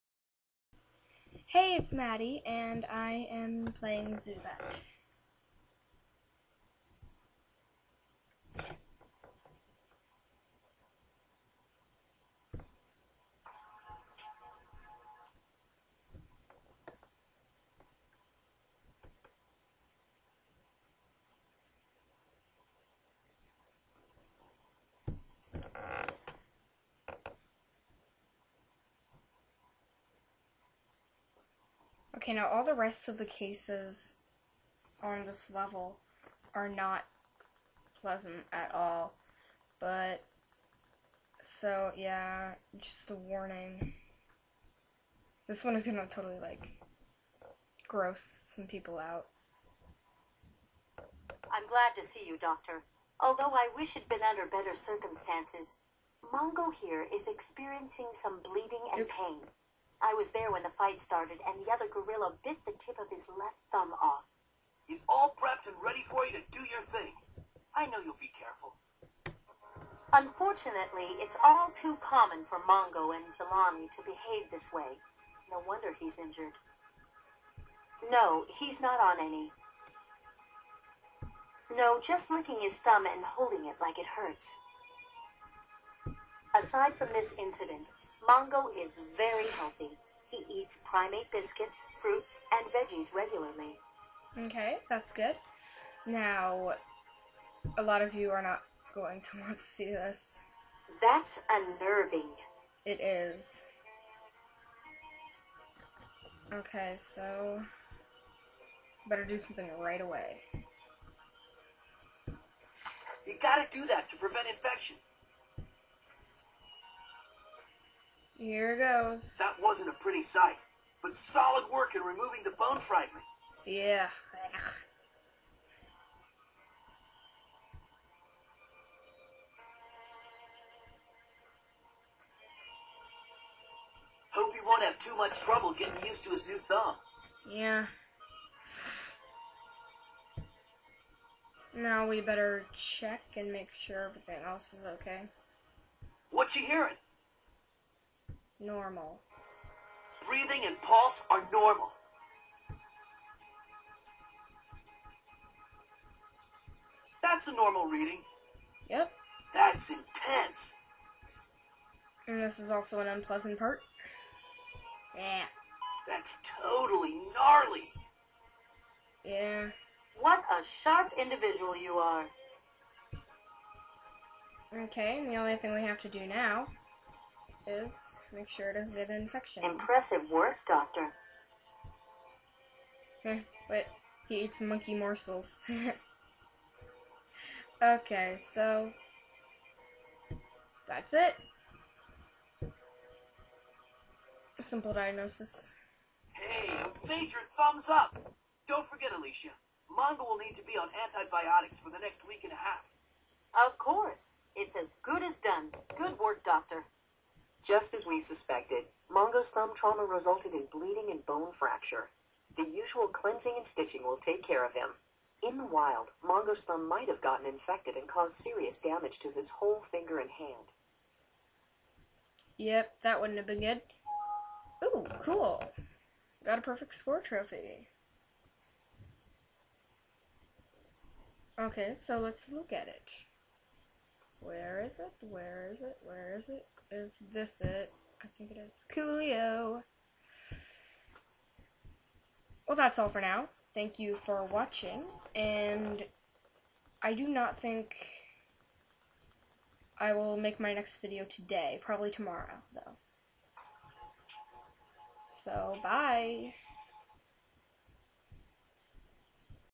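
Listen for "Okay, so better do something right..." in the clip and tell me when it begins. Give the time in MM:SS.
01:46.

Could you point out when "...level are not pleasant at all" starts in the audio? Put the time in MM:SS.
00:35.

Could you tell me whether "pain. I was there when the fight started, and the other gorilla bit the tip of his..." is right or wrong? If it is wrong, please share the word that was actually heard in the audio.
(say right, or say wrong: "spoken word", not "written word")
right.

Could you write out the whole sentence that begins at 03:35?
In the wild, Mongo's thumb might have gotten infected and caused serious damage to his whole finger and hand.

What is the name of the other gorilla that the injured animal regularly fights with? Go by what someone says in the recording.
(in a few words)
Jelani.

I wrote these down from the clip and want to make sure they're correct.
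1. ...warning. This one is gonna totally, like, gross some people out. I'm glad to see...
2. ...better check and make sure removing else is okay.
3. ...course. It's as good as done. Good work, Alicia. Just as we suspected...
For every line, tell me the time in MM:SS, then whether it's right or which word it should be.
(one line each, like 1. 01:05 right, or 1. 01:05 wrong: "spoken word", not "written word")
1. 00:43 right
2. 02:22 wrong: "everything", not "removing"
3. 03:23 wrong: "Doctor", not "Alicia".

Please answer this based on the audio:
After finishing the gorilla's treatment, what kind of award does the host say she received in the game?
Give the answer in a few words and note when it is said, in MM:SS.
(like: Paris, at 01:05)
Perfect score trophy, at 03:46.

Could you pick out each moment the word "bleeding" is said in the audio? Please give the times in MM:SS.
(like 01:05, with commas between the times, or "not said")
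00:58, 03:30.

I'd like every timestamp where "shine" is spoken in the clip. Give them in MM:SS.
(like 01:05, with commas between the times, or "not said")
not said.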